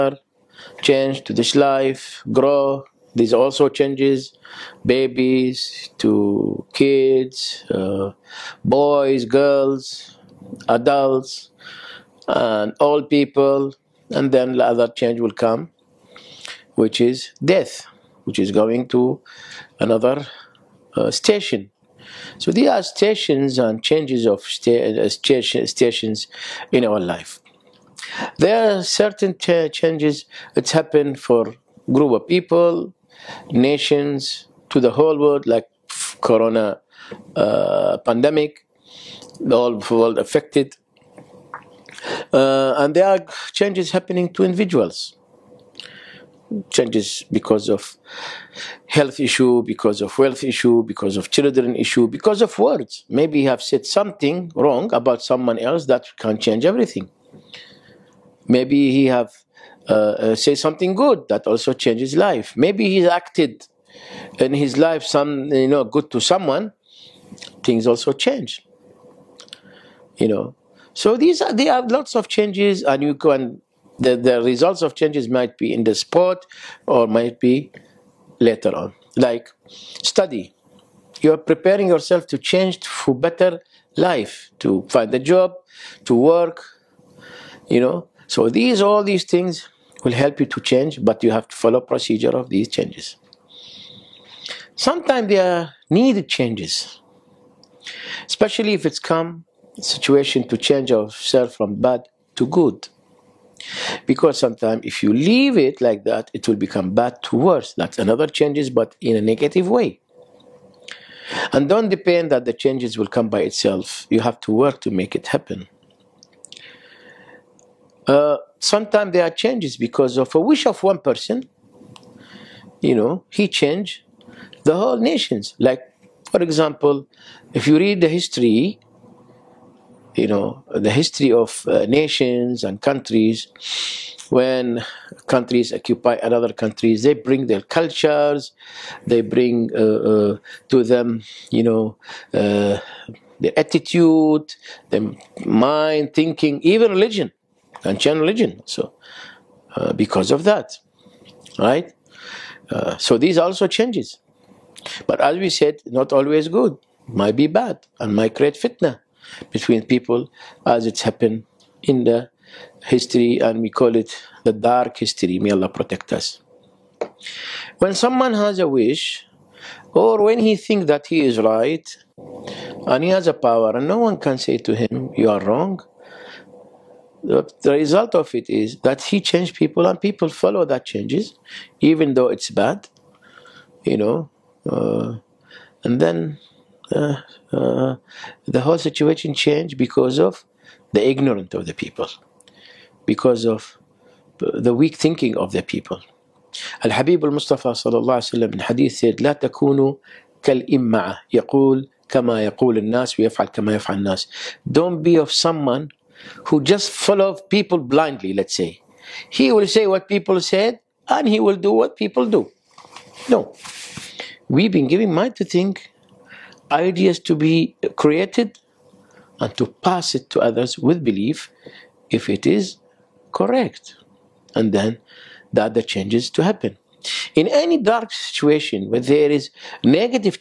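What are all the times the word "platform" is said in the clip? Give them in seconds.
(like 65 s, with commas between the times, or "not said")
not said.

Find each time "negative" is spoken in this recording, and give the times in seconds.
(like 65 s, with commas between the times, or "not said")
109 s, 229 s.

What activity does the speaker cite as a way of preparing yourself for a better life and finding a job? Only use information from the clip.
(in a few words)
Study.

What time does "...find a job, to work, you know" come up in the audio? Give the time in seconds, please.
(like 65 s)
84 s.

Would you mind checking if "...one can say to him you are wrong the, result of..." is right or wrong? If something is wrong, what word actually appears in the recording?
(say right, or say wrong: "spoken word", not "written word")
right.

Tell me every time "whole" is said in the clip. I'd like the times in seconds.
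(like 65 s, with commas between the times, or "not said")
34 s, 39 s, 124 s, 188 s.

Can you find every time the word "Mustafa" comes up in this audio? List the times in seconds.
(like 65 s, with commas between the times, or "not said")
197 s.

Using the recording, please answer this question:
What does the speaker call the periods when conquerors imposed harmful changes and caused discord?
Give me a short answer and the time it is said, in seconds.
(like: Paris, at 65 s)
The dark history, at 164 s.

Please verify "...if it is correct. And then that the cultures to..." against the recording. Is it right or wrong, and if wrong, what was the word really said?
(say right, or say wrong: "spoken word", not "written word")
wrong: "changes", not "cultures".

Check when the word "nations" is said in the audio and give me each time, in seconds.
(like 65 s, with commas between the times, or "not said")
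33 s, 124 s, 131 s.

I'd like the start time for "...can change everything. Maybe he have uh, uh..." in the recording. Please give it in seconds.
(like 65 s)
56 s.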